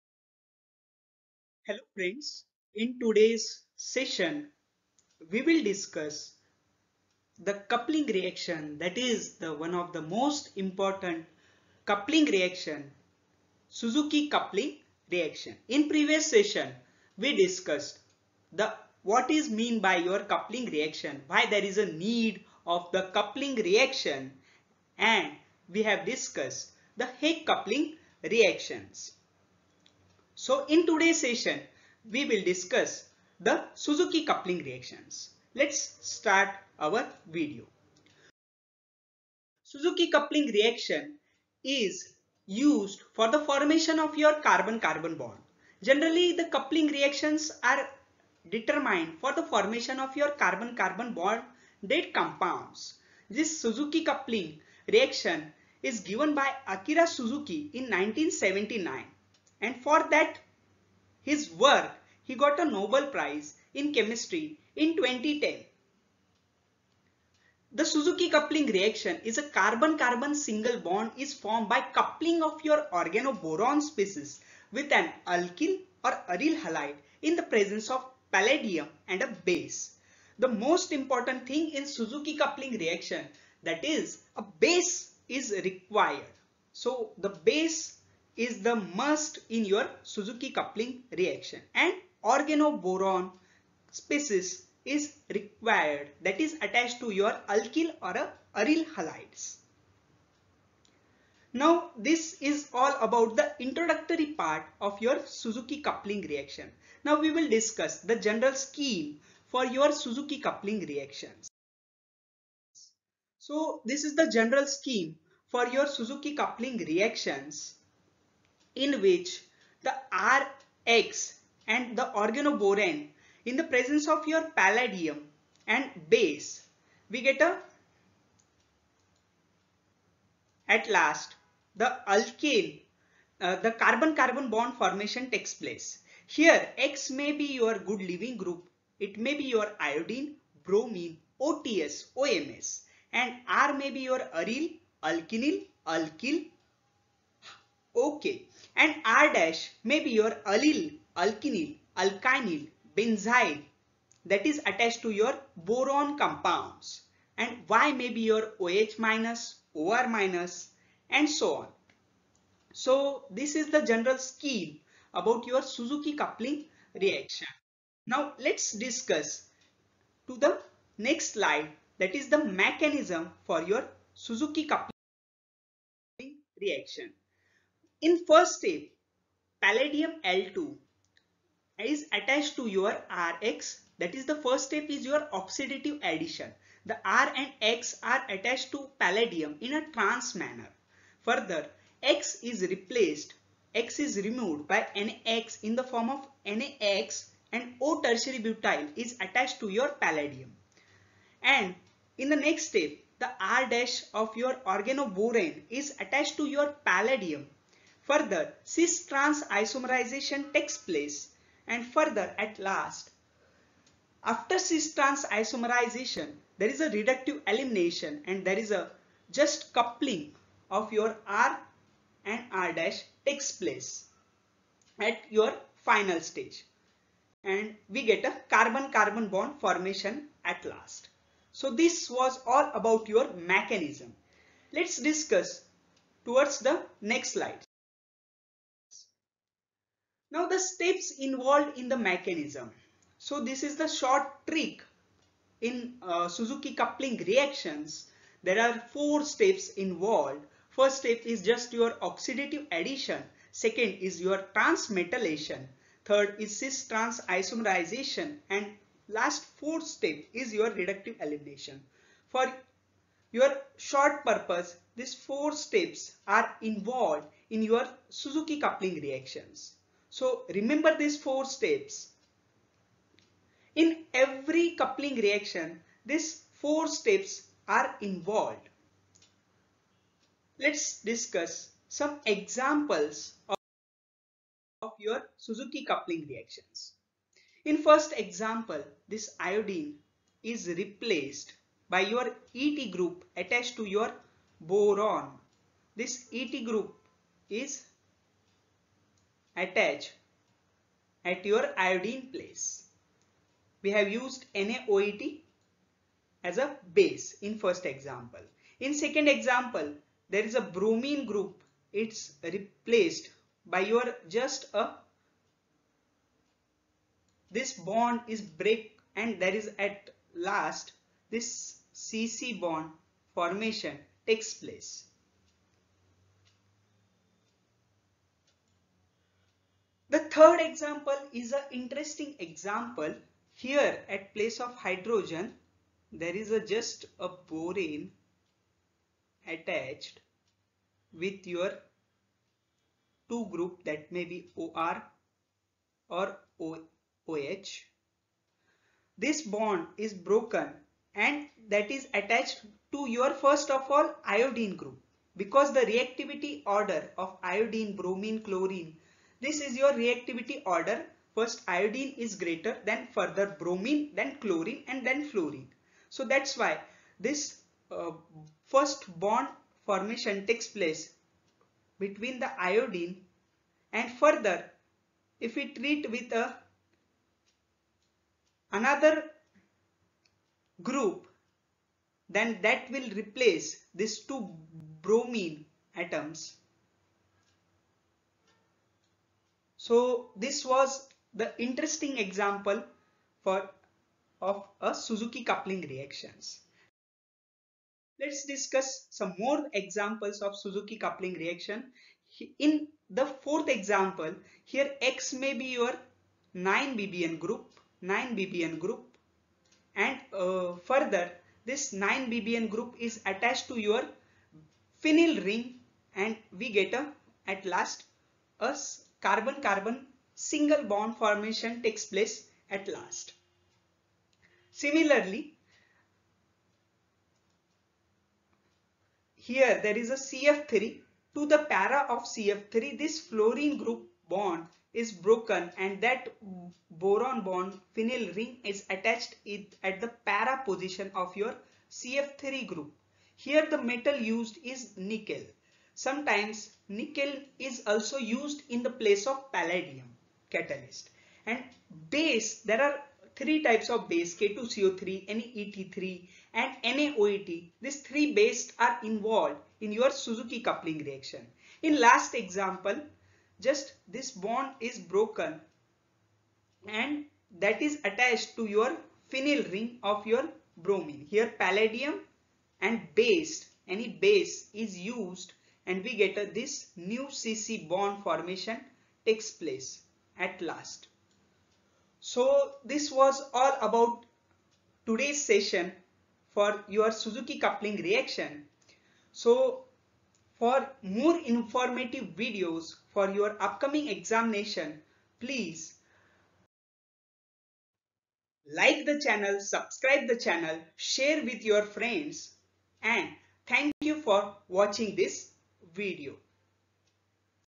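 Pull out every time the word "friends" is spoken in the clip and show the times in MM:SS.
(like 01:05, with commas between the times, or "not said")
00:01, 08:21.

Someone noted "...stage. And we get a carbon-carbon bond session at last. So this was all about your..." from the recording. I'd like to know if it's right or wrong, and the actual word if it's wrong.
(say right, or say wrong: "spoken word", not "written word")
wrong: "formation", not "session".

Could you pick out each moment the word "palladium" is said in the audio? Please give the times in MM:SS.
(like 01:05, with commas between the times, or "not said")
01:18, 02:04, 02:59, 03:08, 03:19, 03:26, 07:29, 07:51.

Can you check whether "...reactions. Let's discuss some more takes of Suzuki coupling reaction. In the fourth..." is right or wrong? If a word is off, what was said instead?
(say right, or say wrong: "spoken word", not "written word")
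wrong: "examples", not "takes".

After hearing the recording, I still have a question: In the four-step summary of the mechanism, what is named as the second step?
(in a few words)
Transmetallation.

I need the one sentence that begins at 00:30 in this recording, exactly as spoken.
So in today's session, we will discuss the Suzuki coupling reactions.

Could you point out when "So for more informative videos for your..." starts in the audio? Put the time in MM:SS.
08:09.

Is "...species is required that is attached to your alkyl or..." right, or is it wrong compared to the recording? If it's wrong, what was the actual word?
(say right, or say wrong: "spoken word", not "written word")
right.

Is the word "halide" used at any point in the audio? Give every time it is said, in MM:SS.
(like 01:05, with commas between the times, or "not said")
01:16, 01:38.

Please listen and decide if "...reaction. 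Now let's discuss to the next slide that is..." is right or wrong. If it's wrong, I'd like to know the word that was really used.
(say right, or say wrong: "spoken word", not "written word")
right.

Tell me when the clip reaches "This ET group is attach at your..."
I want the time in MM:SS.
04:55.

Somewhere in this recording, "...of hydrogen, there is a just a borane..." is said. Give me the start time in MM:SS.
05:34.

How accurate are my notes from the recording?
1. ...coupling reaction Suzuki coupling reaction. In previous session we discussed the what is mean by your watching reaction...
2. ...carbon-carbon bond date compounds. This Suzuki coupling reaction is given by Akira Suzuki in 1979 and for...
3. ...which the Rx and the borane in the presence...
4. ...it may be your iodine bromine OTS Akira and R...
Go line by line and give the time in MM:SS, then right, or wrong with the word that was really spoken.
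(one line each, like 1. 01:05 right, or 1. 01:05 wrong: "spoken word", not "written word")
1. 00:11 wrong: "coupling", not "watching"
2. 00:50 right
3. 01:59 wrong: "organoborane", not "borane"
4. 02:19 wrong: "OMS", not "Akira".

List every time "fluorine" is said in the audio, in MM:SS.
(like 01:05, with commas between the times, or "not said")
06:05, 07:13.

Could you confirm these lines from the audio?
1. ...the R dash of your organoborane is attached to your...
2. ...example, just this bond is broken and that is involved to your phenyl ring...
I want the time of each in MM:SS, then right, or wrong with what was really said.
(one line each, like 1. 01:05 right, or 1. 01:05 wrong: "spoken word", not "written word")
1. 03:23 right
2. 07:42 wrong: "attached", not "involved".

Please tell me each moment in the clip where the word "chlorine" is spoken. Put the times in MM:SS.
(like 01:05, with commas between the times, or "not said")
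05:58, 06:04.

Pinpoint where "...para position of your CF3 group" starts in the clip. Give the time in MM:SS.
07:20.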